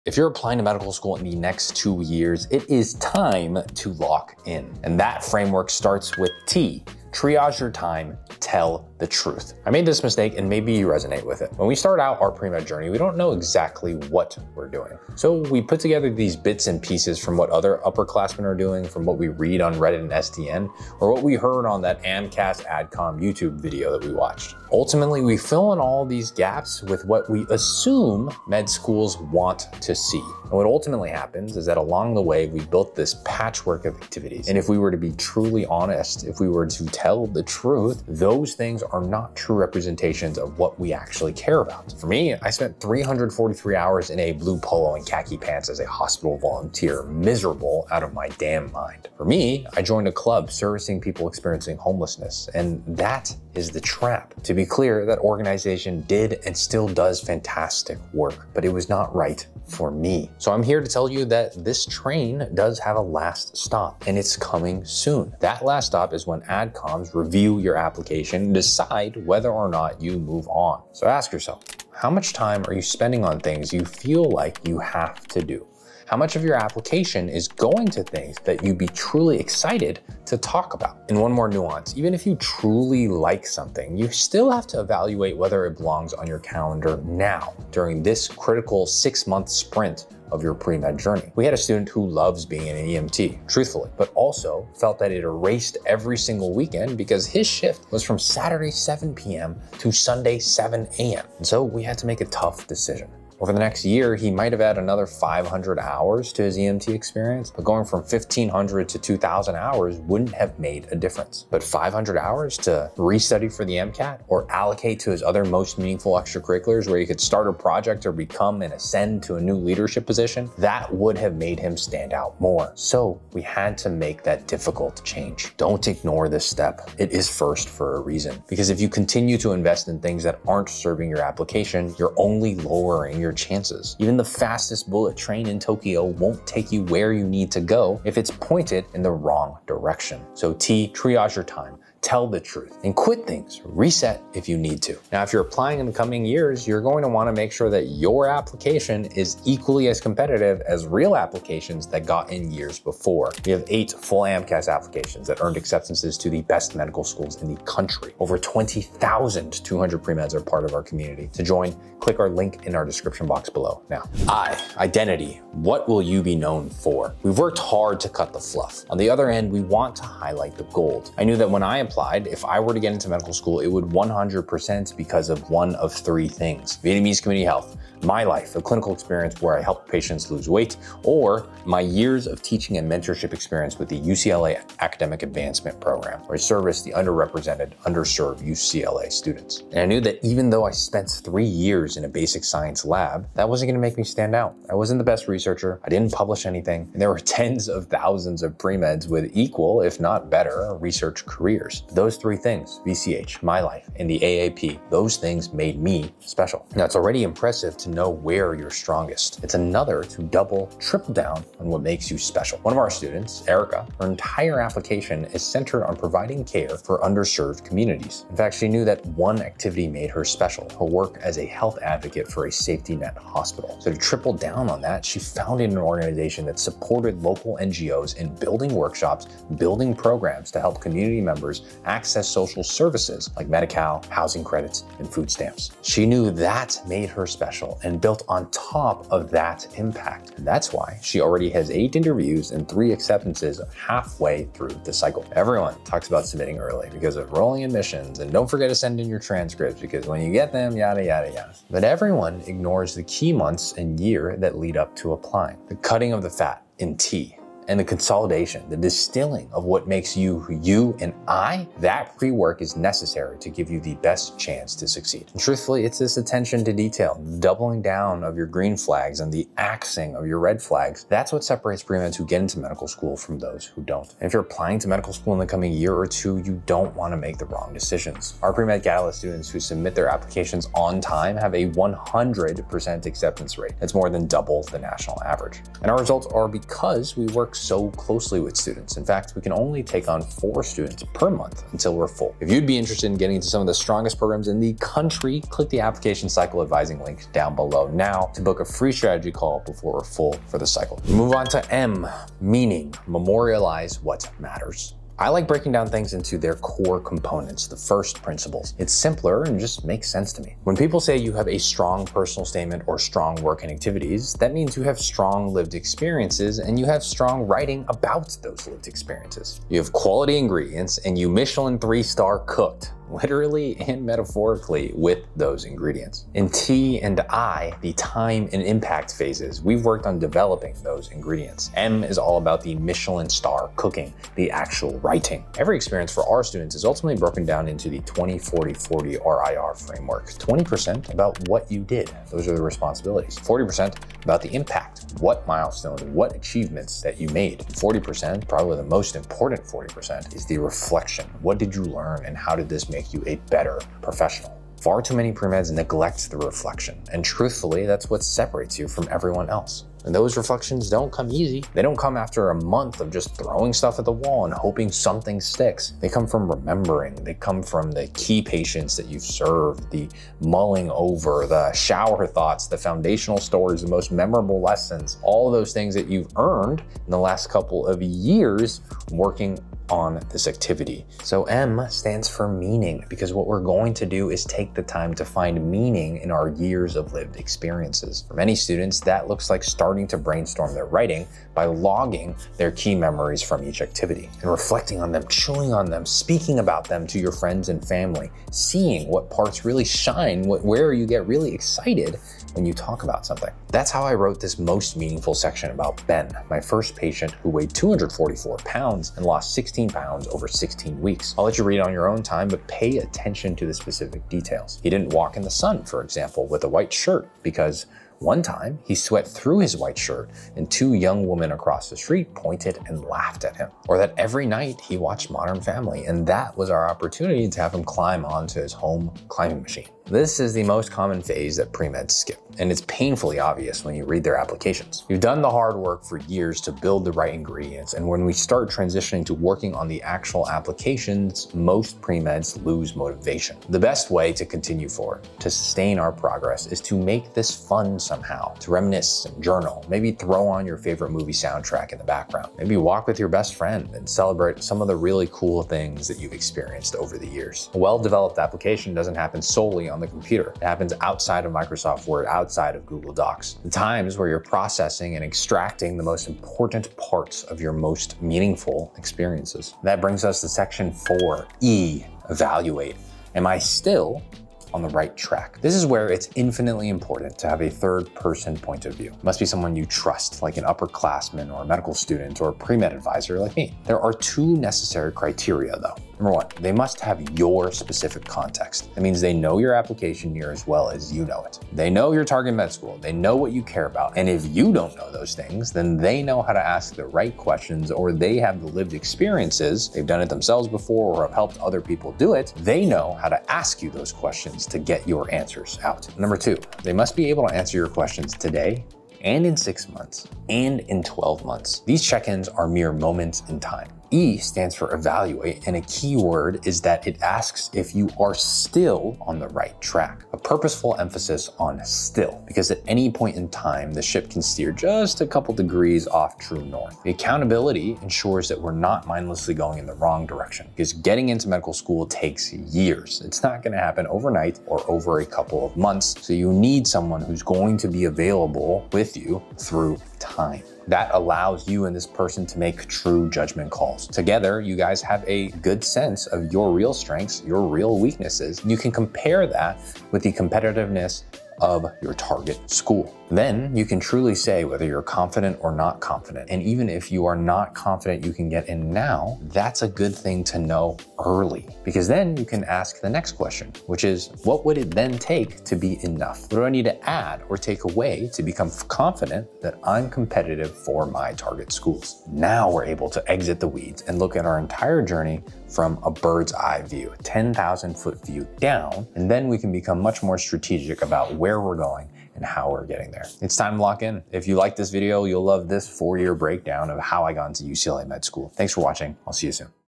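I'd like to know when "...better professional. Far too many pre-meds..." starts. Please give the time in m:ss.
5:53.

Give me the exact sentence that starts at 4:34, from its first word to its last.
And if you're applying to medical school in the coming year or two, you don't want to make the wrong decisions.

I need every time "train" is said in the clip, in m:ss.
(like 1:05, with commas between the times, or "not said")
1:01, 2:15.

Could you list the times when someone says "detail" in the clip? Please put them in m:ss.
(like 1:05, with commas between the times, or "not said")
4:26, 6:54.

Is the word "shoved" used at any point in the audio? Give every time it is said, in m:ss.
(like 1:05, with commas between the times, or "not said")
not said.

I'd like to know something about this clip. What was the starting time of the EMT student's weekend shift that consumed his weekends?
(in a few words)
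Saturday 7 p.m.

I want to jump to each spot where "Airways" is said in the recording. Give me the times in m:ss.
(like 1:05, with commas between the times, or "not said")
not said.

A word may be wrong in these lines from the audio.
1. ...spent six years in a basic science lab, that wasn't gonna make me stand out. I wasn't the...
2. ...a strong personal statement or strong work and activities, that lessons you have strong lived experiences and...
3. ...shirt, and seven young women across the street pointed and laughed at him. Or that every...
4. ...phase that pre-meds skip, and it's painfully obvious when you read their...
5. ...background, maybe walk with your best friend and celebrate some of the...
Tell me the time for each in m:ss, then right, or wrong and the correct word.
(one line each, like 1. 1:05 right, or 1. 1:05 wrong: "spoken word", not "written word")
1. 3:10 wrong: "three", not "six"
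2. 5:11 wrong: "means", not "lessons"
3. 6:59 wrong: "two", not "seven"
4. 7:11 right
5. 7:32 right.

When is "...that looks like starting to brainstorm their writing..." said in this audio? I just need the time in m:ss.
6:29.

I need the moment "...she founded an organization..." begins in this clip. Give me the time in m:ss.
3:45.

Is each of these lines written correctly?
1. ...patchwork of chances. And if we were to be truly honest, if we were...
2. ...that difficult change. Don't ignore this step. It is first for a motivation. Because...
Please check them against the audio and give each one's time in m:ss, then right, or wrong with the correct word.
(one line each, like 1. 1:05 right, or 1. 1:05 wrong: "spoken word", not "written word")
1. 0:33 wrong: "activities", not "chances"
2. 2:04 wrong: "reason", not "motivation".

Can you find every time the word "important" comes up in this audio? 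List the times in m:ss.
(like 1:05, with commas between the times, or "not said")
5:49, 7:46, 7:56.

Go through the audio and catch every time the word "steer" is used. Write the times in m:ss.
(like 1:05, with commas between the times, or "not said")
8:44.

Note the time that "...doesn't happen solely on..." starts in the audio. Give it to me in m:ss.
7:38.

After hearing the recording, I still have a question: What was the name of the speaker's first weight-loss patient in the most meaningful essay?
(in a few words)
Ben.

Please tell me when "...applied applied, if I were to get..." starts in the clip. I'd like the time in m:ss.
2:51.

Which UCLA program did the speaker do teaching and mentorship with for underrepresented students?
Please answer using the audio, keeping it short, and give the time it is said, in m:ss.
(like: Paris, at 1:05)
Academic Advancement Program, at 3:04.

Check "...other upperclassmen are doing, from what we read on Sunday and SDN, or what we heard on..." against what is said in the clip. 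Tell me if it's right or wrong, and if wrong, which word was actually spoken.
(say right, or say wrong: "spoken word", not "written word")
wrong: "Reddit", not "Sunday".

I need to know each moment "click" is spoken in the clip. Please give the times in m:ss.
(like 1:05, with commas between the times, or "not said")
2:41, 4:55.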